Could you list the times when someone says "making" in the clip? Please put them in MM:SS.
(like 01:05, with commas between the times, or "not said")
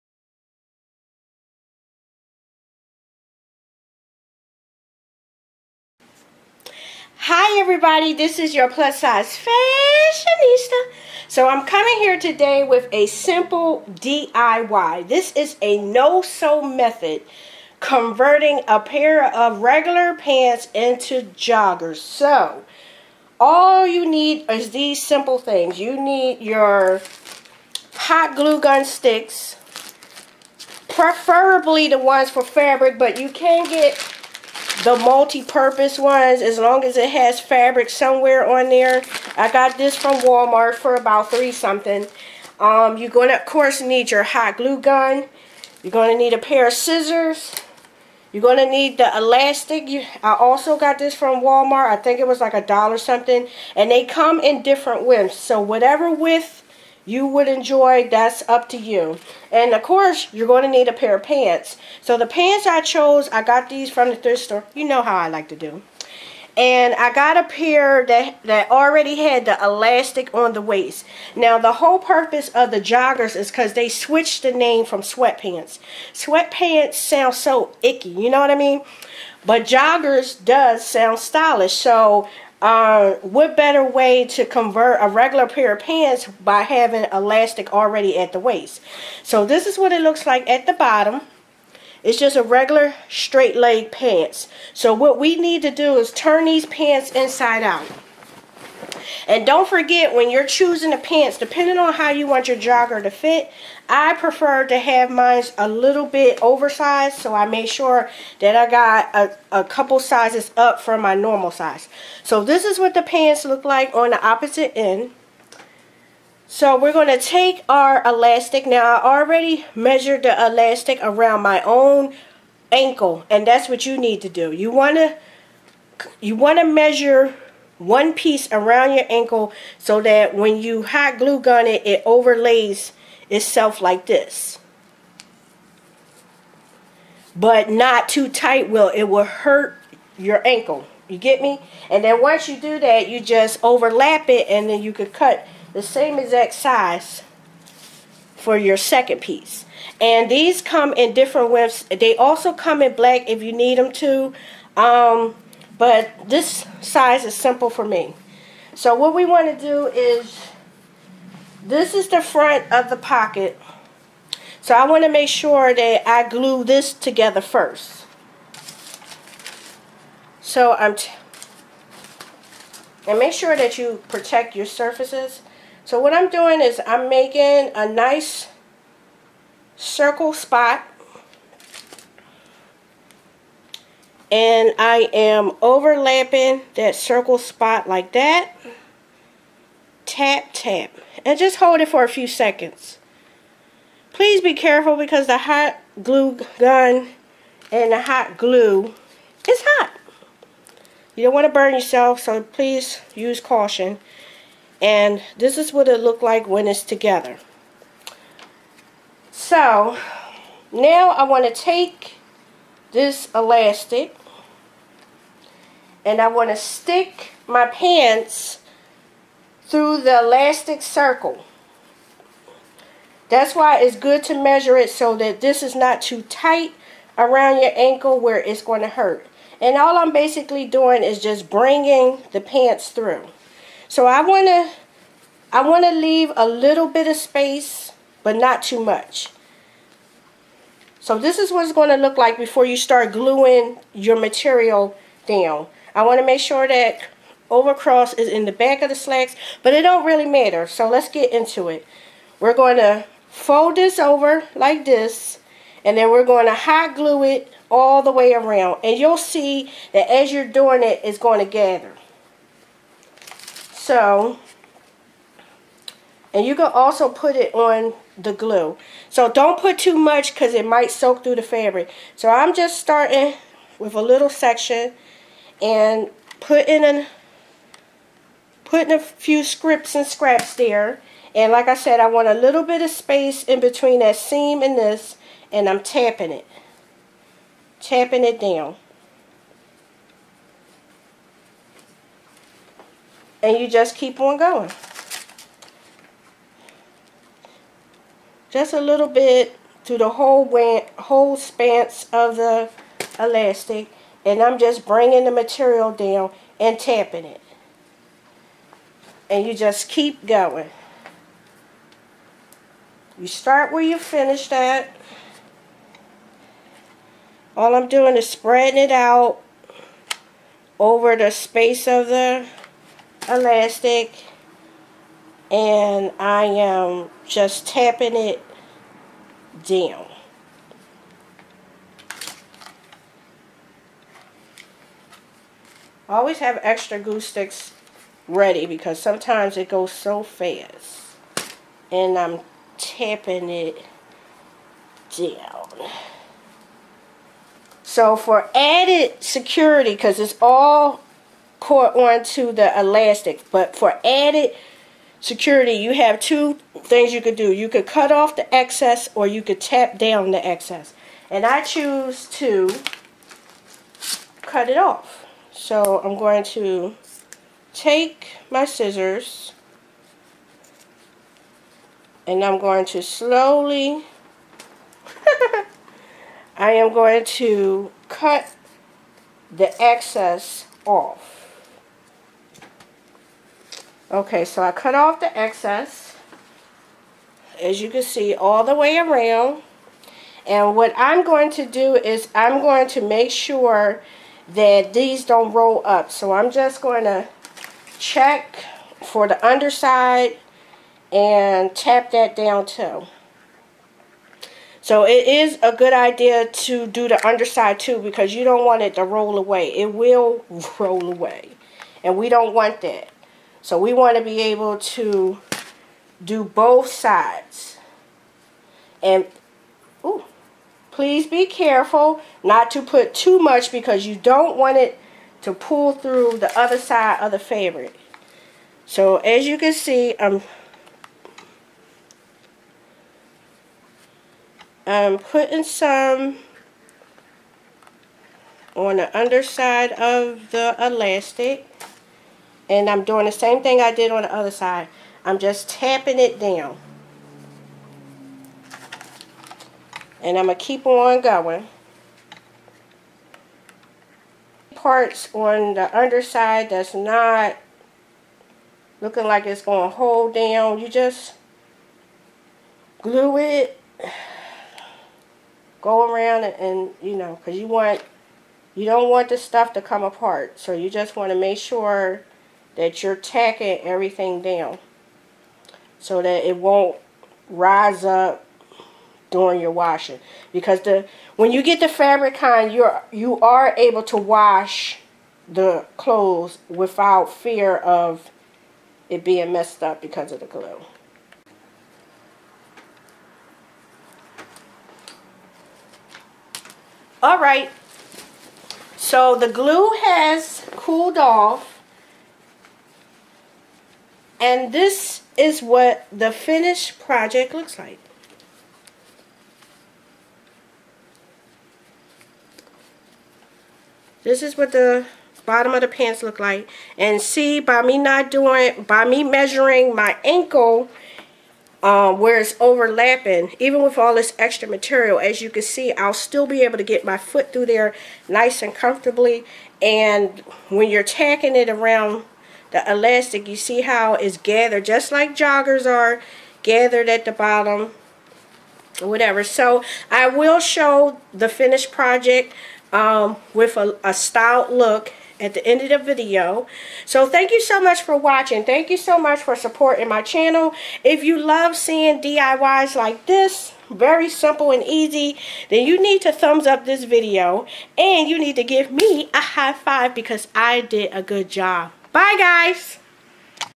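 02:57.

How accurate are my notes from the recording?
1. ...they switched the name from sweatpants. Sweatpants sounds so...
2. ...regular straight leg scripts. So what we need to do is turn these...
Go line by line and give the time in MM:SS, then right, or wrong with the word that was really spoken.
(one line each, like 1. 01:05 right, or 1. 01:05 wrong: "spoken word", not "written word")
1. 01:13 right
2. 01:32 wrong: "pants", not "scripts".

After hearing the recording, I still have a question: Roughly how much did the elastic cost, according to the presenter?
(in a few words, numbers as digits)
a dollar something.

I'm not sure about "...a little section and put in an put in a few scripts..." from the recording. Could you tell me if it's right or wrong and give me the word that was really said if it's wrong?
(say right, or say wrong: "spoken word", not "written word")
right.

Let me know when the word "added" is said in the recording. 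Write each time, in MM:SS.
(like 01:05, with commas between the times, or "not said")
05:48, 05:54.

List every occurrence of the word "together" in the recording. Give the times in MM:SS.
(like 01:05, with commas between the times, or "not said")
02:46, 03:26.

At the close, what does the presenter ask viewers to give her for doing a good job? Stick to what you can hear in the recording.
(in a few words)
a high five.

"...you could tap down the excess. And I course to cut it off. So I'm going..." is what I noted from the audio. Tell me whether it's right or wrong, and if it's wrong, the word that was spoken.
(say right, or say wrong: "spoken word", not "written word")
wrong: "choose", not "course".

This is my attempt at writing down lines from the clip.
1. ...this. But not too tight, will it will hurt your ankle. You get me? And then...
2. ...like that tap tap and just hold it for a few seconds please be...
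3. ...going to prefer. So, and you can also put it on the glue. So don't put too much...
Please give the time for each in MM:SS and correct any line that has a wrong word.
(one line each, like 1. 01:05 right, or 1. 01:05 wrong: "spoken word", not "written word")
1. 02:14 right
2. 03:07 right
3. 04:21 wrong: "gather", not "prefer".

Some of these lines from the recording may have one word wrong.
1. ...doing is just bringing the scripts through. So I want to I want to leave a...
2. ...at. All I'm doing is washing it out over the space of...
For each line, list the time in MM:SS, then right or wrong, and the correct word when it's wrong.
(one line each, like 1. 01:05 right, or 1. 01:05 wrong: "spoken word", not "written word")
1. 03:50 wrong: "pants", not "scripts"
2. 05:14 wrong: "spreading", not "washing".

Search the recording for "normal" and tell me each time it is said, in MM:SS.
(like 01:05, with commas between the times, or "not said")
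01:51.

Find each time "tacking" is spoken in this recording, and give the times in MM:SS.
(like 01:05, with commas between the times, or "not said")
07:53, 08:51.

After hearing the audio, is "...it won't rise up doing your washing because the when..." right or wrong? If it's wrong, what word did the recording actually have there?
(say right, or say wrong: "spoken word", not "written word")
right.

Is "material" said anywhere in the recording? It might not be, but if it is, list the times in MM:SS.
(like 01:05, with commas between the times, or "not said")
04:04, 05:05, 08:44.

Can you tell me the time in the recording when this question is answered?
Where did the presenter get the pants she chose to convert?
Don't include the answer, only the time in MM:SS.
01:04.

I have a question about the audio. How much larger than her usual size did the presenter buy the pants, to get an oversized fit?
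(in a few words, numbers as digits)
a couple sizes up.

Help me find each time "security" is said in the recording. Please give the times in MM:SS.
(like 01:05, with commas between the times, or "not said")
05:49, 05:55.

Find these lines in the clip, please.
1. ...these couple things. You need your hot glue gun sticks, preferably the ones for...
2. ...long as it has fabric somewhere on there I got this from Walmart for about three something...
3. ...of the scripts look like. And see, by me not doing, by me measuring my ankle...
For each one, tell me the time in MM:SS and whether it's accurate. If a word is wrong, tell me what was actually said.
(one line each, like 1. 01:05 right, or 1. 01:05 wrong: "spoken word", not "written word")
1. 00:24 wrong: "simple", not "couple"
2. 00:36 right
3. 08:35 wrong: "pants", not "scripts".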